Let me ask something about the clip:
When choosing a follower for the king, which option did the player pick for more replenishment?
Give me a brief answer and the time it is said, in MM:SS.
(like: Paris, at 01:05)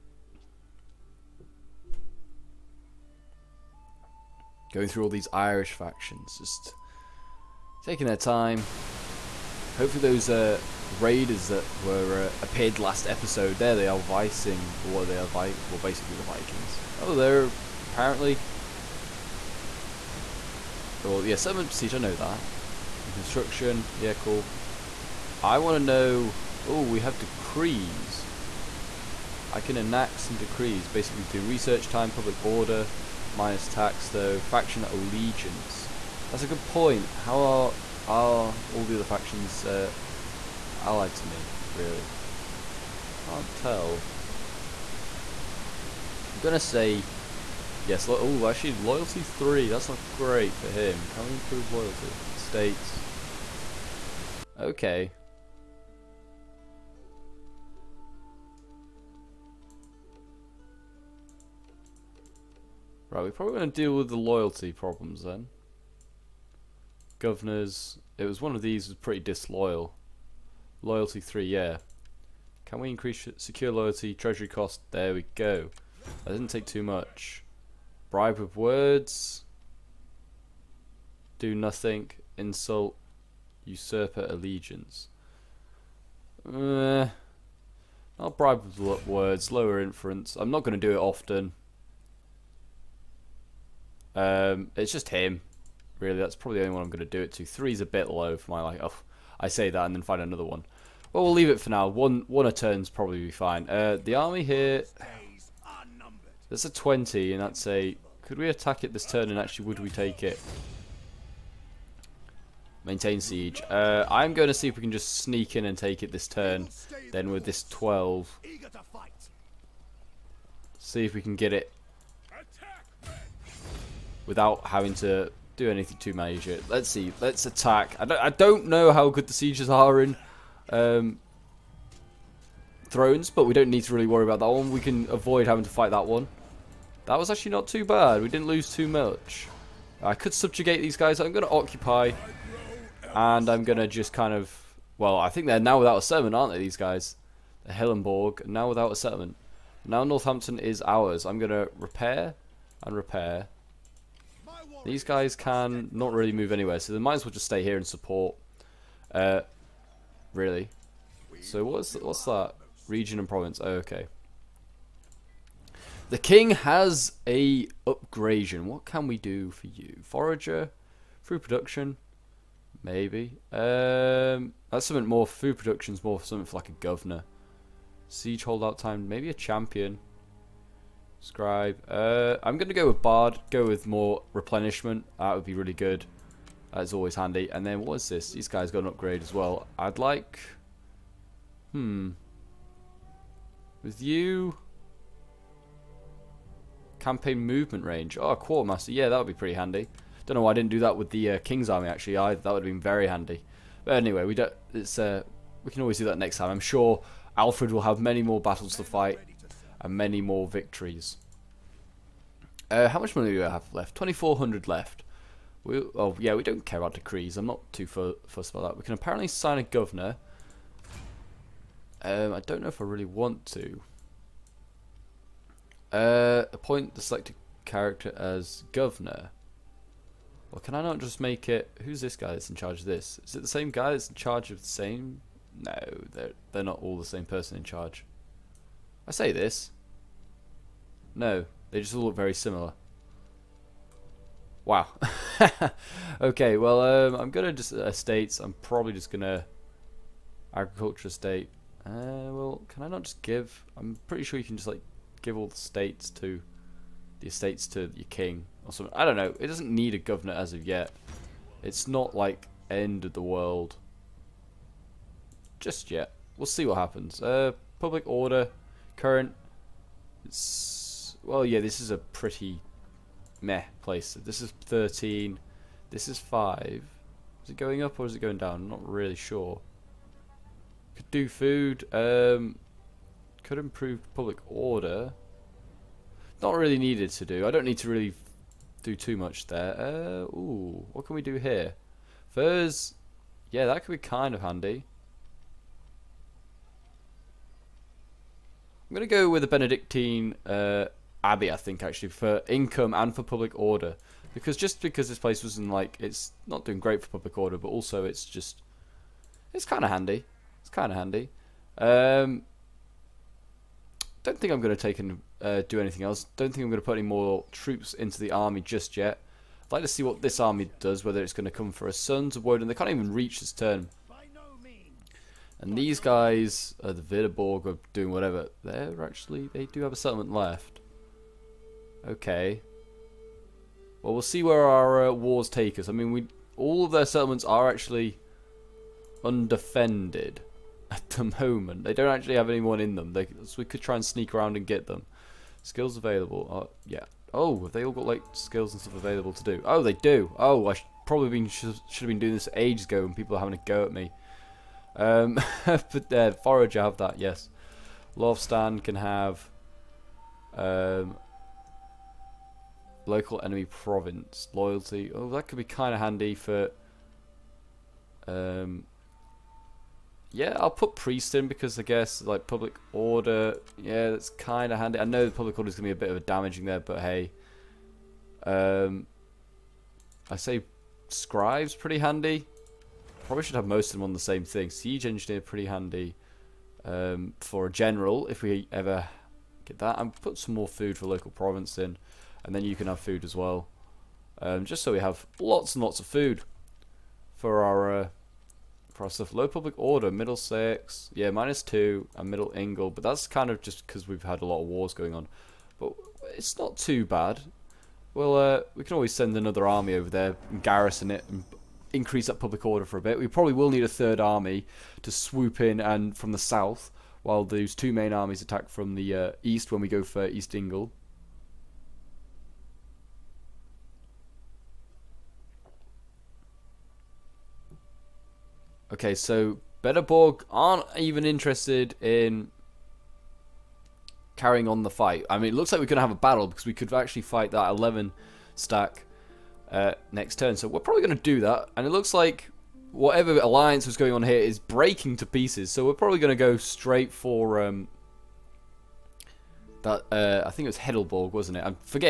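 Bard, at 03:03.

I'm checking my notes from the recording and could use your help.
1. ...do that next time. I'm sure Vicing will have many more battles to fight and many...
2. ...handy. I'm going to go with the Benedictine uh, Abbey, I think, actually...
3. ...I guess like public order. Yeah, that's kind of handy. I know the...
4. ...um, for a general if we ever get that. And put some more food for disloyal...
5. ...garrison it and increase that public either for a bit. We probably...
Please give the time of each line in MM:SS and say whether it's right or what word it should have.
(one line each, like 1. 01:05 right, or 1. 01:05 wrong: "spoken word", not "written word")
1. 03:25 wrong: "Alfred", not "Vicing"
2. 04:54 right
3. 06:11 right
4. 06:26 wrong: "local", not "disloyal"
5. 06:50 wrong: "order", not "either".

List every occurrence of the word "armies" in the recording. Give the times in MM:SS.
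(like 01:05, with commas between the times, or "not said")
06:58.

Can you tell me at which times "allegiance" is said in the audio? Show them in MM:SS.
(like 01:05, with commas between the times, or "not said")
00:34, 01:24.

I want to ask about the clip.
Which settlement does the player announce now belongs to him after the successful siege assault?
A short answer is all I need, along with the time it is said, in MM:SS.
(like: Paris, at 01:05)
Northampton, at 02:30.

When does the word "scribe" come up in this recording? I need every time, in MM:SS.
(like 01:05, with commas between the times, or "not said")
03:01, 06:21.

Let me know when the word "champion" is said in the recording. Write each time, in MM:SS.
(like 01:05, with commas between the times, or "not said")
02:59.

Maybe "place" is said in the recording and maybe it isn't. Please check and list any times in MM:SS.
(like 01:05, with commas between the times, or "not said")
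04:33, 05:05.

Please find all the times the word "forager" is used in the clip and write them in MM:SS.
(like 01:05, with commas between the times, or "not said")
02:50, 05:56.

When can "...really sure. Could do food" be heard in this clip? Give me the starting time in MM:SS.
04:38.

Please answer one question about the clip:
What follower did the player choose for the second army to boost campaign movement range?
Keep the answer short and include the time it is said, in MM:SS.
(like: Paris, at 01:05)
Quartermaster, at 03:18.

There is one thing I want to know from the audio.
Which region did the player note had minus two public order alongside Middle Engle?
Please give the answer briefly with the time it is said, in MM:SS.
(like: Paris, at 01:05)
Middlesex, at 06:40.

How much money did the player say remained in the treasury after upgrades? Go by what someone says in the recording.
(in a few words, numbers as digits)
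2,400.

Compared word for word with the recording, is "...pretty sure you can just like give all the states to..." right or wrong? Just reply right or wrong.
right.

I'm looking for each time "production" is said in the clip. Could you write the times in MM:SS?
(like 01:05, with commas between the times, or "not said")
02:51, 02:55.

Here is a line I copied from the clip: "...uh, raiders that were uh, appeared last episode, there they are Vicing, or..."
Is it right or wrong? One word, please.
right.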